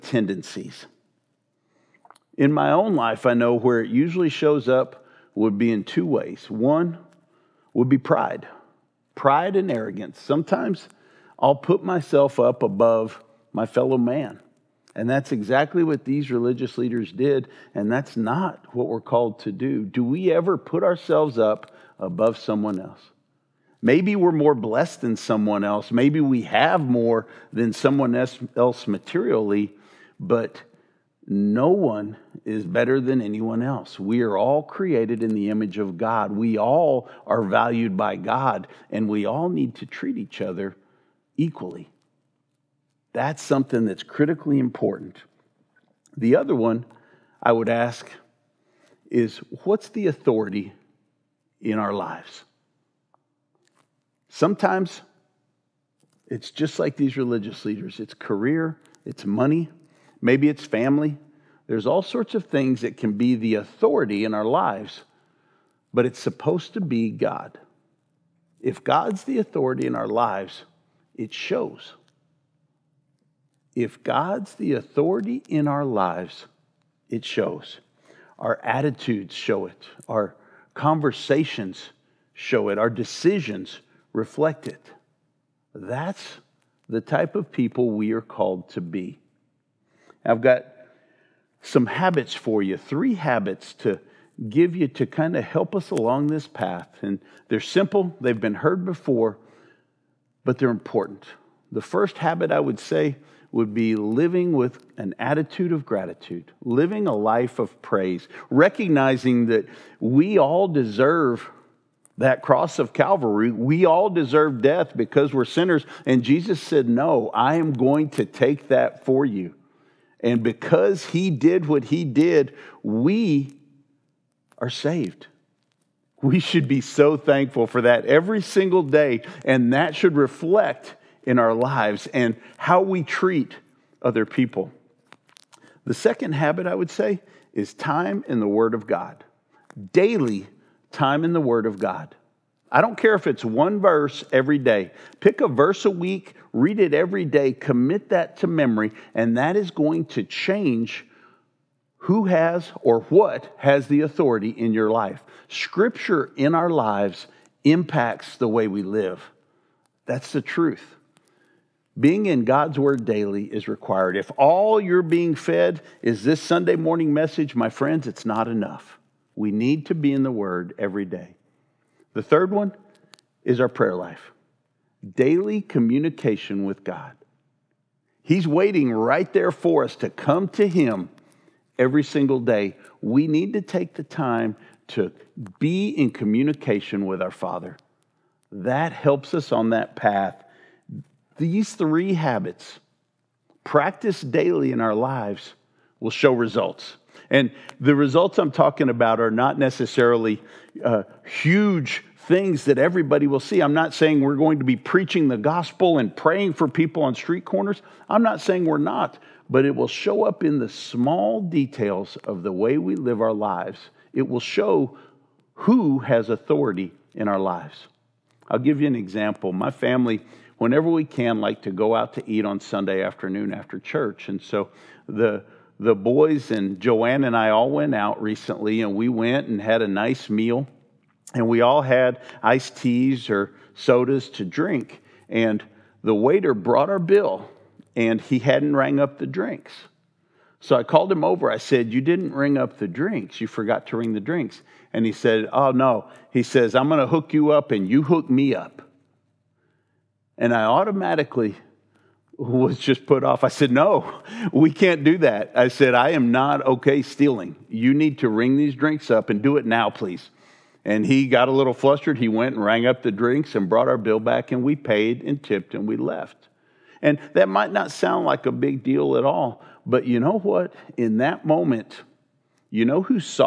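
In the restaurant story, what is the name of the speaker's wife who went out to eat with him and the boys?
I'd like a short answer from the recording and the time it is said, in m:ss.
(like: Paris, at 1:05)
Joanne, at 3:46.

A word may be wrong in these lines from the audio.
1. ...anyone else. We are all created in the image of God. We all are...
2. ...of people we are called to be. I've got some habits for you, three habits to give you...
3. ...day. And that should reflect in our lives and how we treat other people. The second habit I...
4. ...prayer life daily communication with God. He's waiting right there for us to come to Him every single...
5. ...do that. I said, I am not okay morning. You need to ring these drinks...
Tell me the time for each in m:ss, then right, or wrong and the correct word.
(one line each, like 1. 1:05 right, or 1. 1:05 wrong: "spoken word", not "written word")
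1. 0:33 right
2. 1:27 right
3. 2:08 right
4. 2:53 right
5. 4:15 wrong: "stealing", not "morning".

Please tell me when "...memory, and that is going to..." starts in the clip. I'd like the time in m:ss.
2:28.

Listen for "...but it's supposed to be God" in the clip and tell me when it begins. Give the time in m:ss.
1:05.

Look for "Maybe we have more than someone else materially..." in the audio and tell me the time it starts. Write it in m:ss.
0:25.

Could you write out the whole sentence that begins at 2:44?
If all you're being fed is this Sunday morning message, my friends, it's not enough.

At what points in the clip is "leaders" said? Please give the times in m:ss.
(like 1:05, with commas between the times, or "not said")
0:16, 0:57.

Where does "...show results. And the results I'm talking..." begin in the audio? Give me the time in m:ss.
3:16.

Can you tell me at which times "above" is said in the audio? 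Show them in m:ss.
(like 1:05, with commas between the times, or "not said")
0:12, 0:21.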